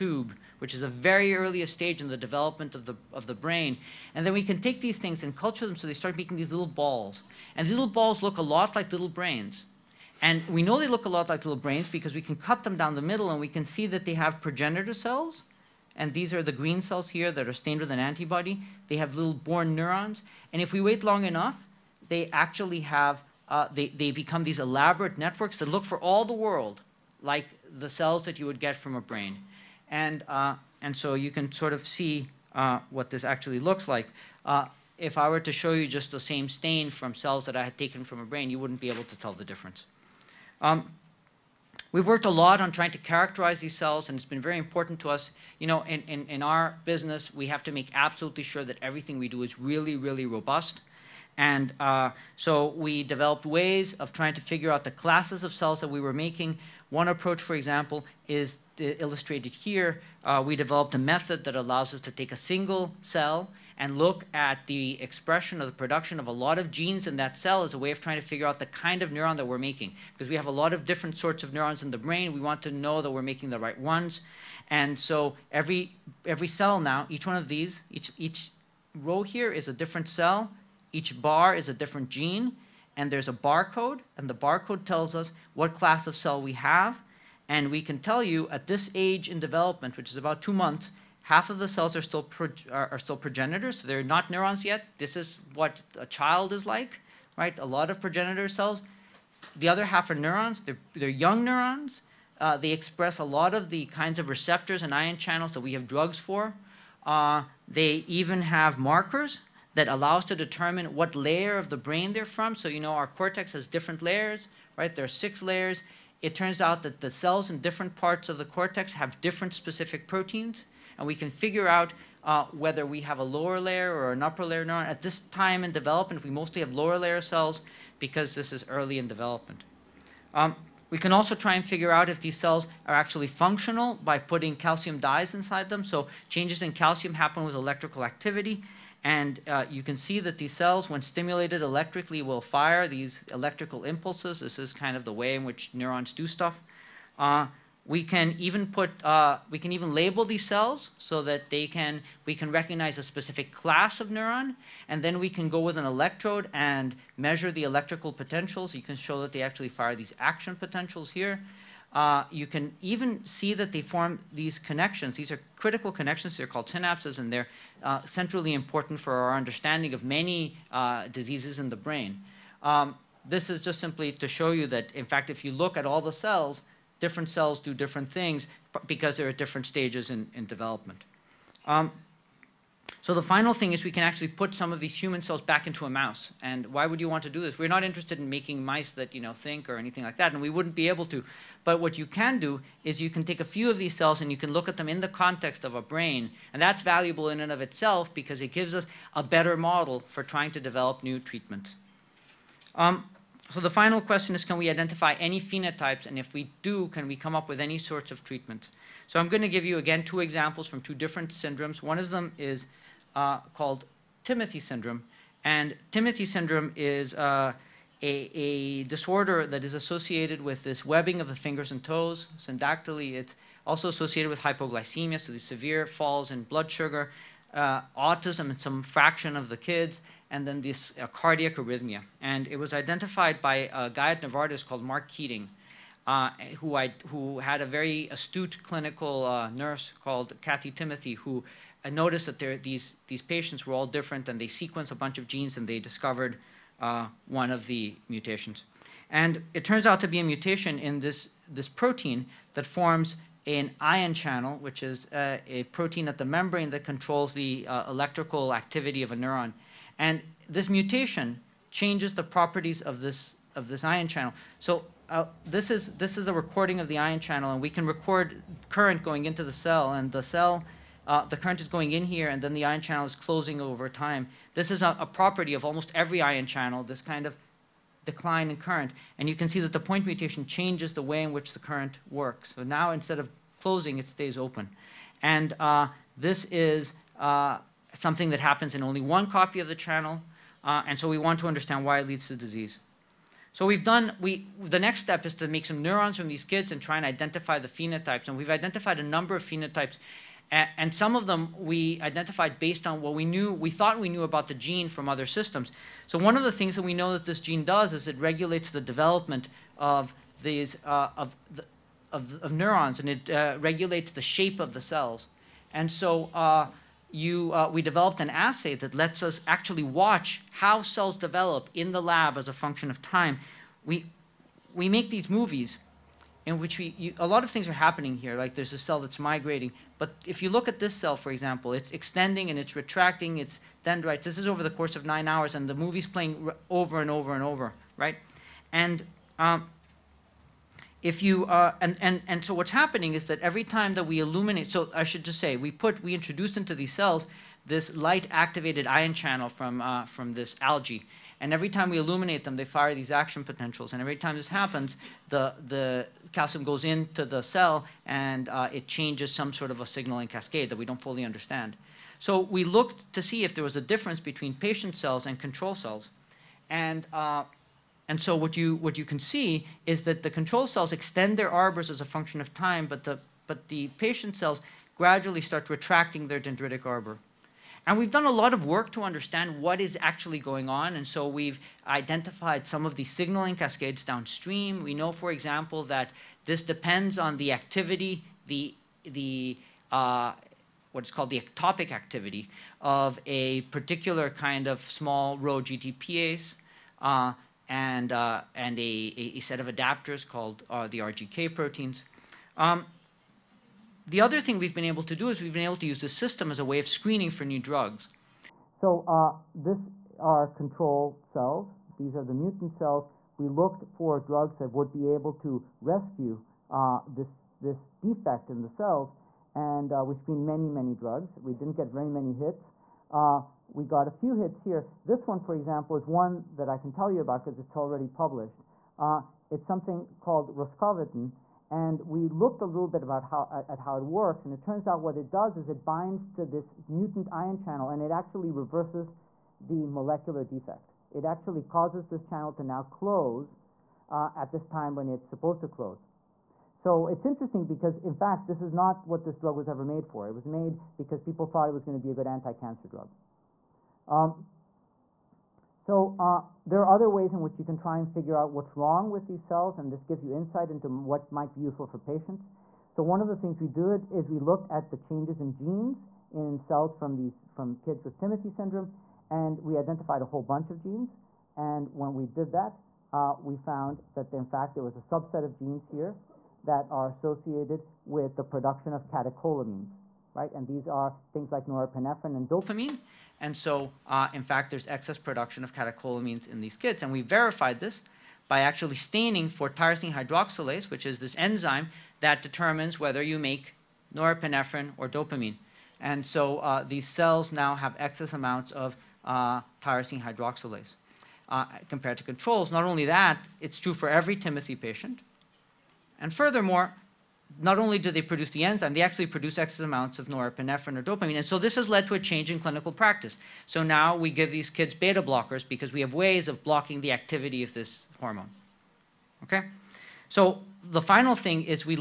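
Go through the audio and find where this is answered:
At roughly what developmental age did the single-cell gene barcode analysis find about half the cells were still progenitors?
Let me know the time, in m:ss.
1:30.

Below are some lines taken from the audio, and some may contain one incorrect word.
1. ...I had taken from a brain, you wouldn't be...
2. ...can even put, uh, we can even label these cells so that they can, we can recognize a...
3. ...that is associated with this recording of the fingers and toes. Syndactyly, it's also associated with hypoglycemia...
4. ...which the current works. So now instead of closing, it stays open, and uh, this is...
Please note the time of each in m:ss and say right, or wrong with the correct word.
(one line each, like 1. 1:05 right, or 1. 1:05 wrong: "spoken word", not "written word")
1. 0:37 right
2. 2:28 right
3. 3:39 wrong: "webbing", not "recording"
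4. 4:41 right.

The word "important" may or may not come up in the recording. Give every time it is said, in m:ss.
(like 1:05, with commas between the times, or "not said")
0:44, 2:48.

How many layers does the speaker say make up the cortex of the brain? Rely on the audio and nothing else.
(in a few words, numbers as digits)
6.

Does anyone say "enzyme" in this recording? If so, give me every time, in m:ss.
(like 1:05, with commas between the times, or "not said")
8:11, 8:28.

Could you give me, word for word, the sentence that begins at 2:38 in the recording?
You can show that they actually fire these action potentials here.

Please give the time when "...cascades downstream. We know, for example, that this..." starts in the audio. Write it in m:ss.
6:23.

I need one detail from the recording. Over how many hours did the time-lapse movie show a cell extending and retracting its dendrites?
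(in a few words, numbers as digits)
9.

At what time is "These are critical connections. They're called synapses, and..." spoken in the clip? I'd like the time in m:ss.
2:45.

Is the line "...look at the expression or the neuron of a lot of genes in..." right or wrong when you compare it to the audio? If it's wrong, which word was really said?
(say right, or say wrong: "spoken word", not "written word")
wrong: "production", not "neuron".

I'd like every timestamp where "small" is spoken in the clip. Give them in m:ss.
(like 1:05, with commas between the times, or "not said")
6:34.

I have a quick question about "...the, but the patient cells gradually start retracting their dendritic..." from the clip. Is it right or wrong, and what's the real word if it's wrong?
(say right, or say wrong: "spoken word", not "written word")
right.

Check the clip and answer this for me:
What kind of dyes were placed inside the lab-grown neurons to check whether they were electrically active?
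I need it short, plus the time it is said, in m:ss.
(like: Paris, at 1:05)
calcium dyes, at 2:14.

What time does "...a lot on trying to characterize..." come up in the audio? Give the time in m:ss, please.
0:42.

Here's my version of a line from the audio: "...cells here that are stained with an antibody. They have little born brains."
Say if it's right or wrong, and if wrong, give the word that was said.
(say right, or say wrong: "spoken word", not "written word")
wrong: "neurons", not "brains".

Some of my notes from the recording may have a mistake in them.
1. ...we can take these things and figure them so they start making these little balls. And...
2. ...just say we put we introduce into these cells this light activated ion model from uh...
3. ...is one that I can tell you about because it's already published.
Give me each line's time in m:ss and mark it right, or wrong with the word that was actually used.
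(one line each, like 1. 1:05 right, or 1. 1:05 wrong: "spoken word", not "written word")
1. 0:04 wrong: "culture", not "figure"
2. 5:45 wrong: "channel", not "model"
3. 7:05 right.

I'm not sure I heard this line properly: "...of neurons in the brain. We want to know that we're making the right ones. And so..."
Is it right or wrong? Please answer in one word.
right.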